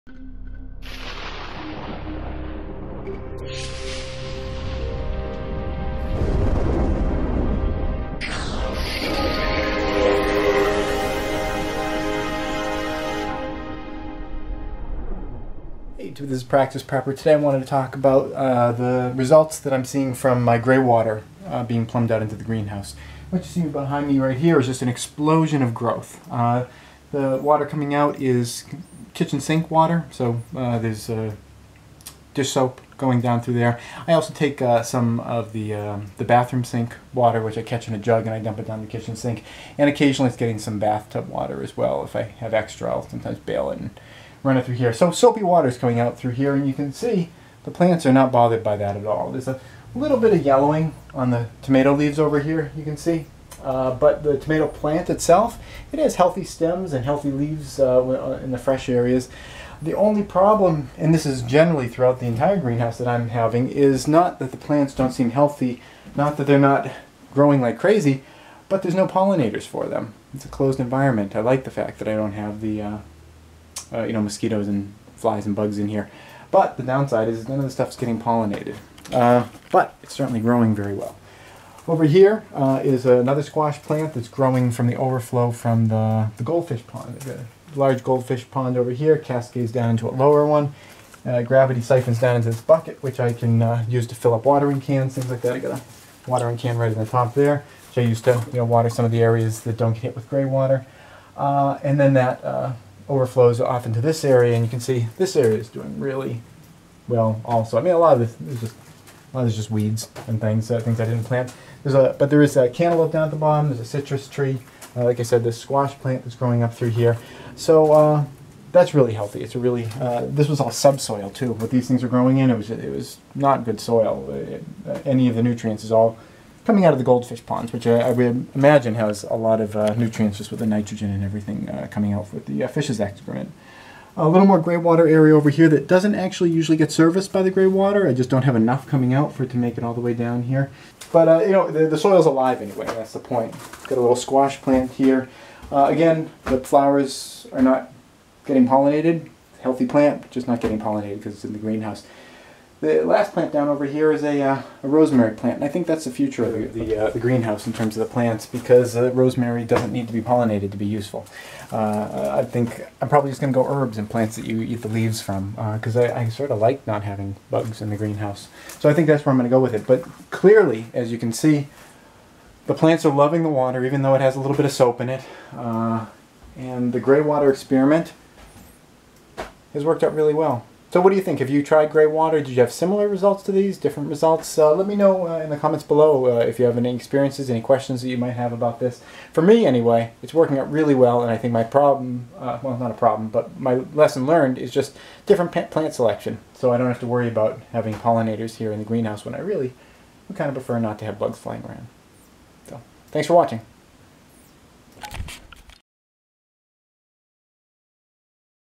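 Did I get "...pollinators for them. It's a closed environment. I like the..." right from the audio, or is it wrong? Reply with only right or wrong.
right.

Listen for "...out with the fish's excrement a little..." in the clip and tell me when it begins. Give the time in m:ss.
2:12.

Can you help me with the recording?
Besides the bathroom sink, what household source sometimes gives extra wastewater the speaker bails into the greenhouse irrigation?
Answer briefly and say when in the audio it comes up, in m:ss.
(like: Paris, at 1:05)
Bathtub water, at 0:40.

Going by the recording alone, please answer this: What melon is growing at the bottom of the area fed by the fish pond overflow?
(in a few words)
Cantaloupe.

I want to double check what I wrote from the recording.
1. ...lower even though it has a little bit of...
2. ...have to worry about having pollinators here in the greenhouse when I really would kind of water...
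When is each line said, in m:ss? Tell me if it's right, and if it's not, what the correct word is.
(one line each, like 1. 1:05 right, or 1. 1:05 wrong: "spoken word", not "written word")
1. 2:53 wrong: "water", not "lower"
2. 3:16 wrong: "prefer", not "water".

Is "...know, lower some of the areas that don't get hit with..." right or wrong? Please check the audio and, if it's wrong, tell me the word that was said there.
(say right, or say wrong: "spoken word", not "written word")
wrong: "water", not "lower".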